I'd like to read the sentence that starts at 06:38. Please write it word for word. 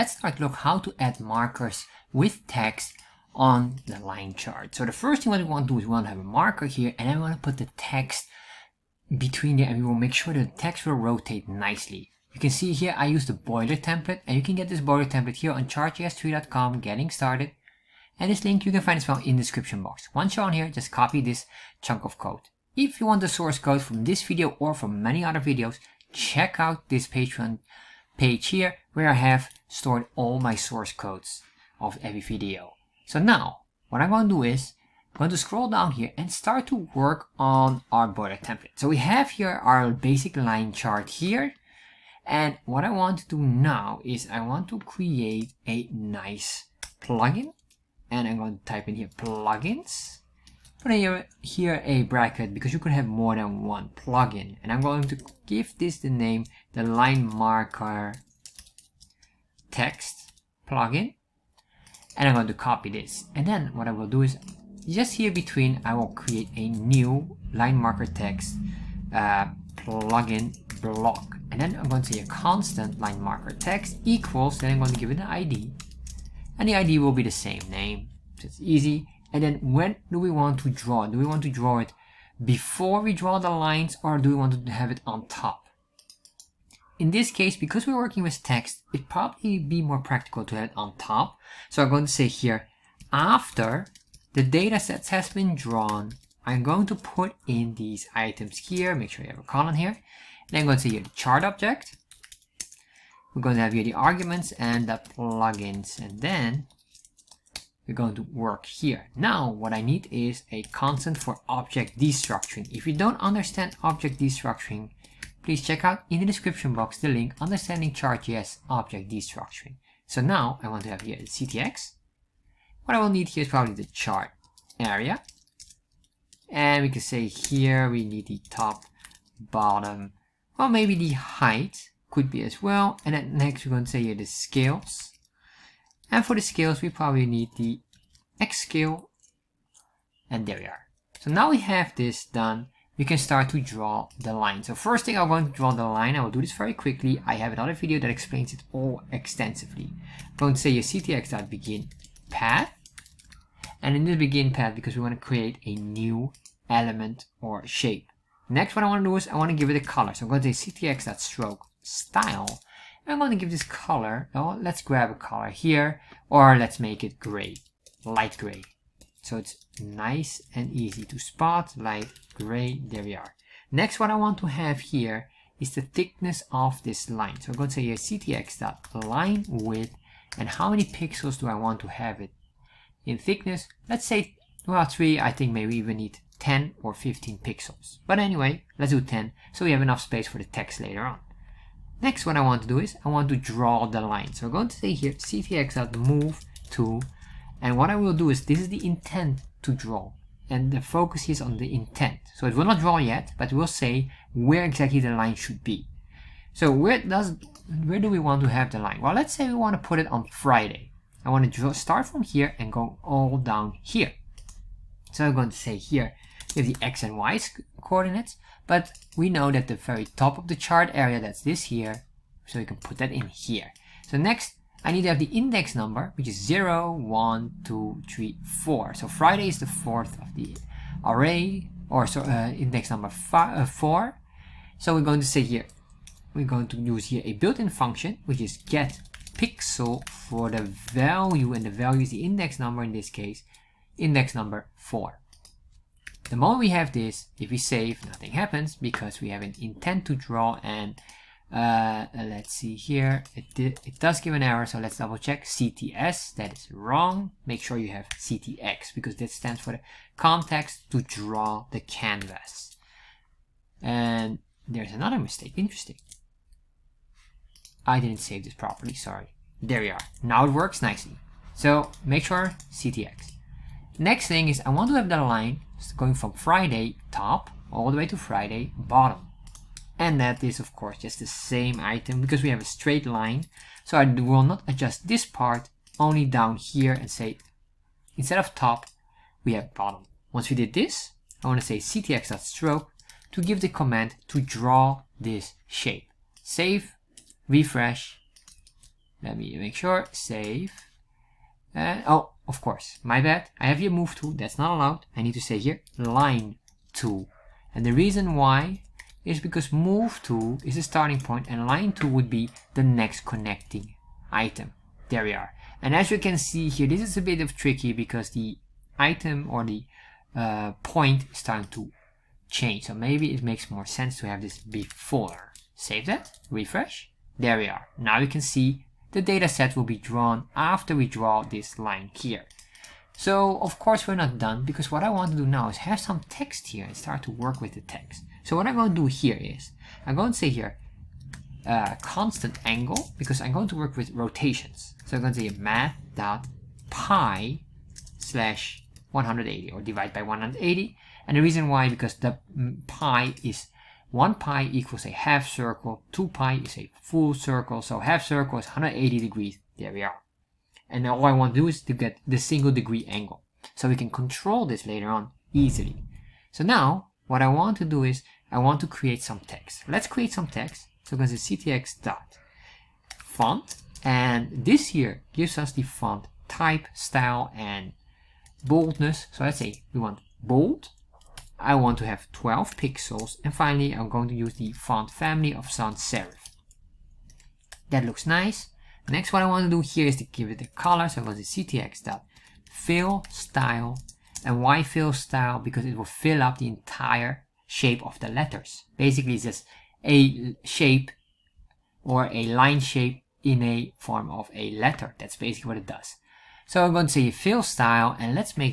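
Basically, it's just a shape or a line shape in a form of a letter.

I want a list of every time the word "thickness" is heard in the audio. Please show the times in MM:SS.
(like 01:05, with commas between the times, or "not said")
02:55, 03:03.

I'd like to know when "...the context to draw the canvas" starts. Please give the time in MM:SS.
04:19.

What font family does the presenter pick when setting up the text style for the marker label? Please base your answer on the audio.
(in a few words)
sans serif.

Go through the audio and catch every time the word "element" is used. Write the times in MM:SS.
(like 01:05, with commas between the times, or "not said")
02:36.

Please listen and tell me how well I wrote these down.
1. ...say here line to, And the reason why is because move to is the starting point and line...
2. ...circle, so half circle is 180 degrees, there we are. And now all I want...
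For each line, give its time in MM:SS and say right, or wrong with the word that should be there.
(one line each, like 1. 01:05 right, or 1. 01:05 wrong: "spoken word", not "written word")
1. 05:05 right
2. 05:57 right.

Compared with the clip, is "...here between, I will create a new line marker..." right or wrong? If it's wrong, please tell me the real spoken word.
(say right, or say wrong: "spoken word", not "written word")
right.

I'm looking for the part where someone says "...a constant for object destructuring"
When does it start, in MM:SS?
01:50.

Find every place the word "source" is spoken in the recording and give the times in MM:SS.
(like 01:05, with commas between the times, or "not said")
00:23, 00:30.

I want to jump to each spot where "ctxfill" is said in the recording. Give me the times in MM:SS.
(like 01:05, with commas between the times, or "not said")
06:31.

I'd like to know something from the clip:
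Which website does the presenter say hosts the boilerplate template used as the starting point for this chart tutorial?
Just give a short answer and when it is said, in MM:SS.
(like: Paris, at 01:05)
chartjs3.com, at 00:15.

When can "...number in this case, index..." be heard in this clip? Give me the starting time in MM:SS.
04:02.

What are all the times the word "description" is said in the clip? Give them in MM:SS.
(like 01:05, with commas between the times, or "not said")
00:19, 01:56.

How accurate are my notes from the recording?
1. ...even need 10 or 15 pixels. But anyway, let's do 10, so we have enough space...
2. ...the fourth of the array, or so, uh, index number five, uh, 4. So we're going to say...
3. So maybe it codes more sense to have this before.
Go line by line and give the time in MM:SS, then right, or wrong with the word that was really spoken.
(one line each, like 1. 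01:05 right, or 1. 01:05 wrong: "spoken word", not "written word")
1. 03:05 right
2. 03:49 right
3. 05:22 wrong: "makes", not "codes".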